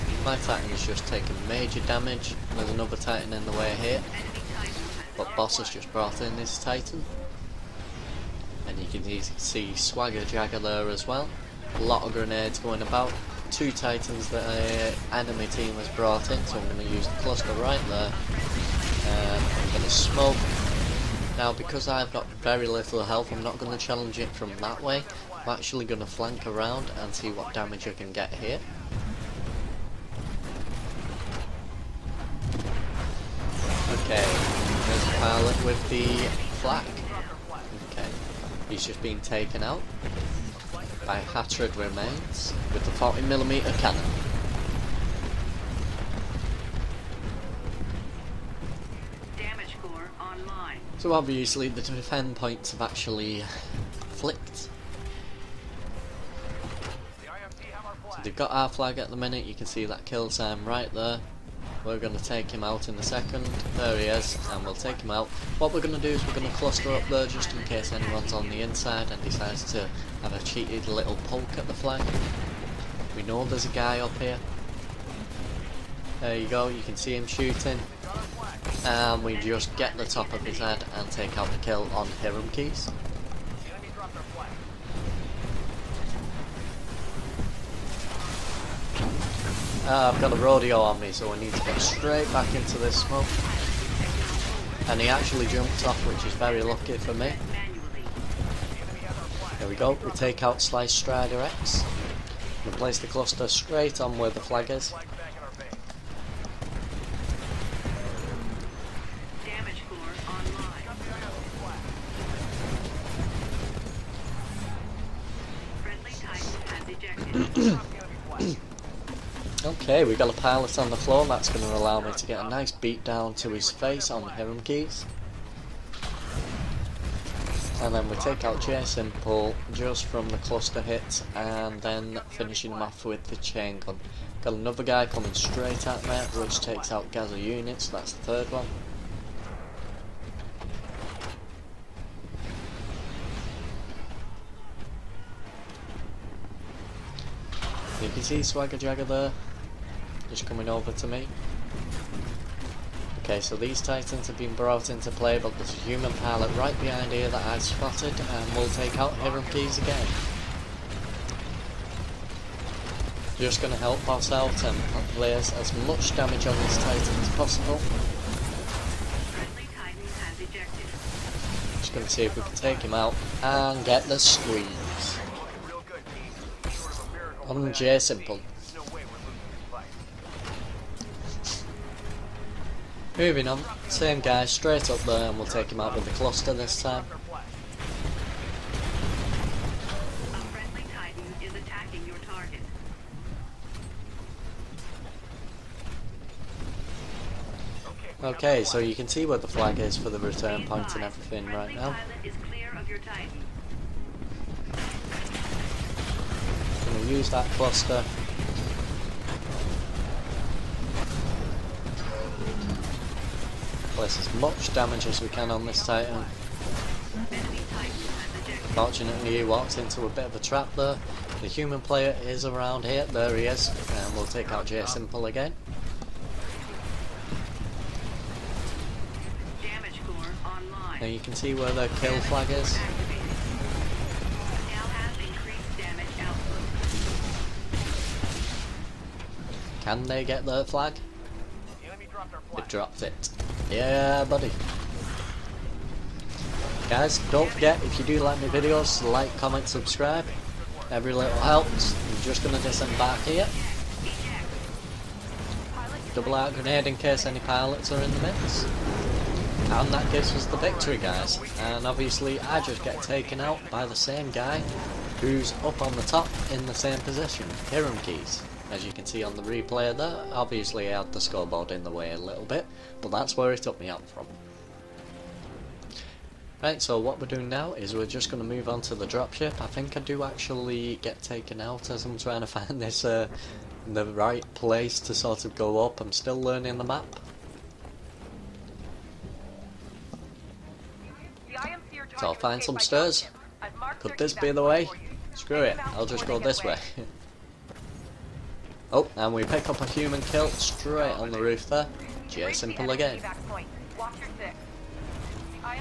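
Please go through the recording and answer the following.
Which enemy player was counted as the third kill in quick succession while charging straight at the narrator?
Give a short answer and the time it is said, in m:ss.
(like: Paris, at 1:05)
Gaza units, at 2:17.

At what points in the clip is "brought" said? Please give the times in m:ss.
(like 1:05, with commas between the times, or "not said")
0:05, 0:15, 2:34.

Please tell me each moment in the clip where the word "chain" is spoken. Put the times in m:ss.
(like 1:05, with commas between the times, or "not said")
2:13.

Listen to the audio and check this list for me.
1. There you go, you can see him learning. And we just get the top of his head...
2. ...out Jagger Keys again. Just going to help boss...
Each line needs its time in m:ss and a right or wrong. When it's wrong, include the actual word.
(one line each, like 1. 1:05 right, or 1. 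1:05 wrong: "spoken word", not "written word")
1. 1:16 wrong: "shooting", not "learning"
2. 2:38 wrong: "Hiram", not "Jagger".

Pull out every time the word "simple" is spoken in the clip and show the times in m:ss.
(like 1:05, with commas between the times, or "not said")
2:08, 2:57, 3:44, 5:02.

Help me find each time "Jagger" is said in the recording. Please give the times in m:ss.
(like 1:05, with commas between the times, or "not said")
0:10, 2:28.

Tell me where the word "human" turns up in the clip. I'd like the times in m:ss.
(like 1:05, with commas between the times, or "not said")
2:35, 3:41, 4:59.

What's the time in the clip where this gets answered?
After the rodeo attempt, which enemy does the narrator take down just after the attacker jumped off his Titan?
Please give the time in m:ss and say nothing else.
1:40.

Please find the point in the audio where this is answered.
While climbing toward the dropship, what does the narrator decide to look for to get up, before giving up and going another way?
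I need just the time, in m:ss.
4:52.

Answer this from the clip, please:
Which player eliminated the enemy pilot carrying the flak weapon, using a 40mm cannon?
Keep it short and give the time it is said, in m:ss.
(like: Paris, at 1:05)
Hatred Remains, at 0:41.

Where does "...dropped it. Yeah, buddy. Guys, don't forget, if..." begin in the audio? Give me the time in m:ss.
4:02.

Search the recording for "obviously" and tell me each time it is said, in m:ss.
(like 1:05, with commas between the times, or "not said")
0:51, 4:21, 4:30.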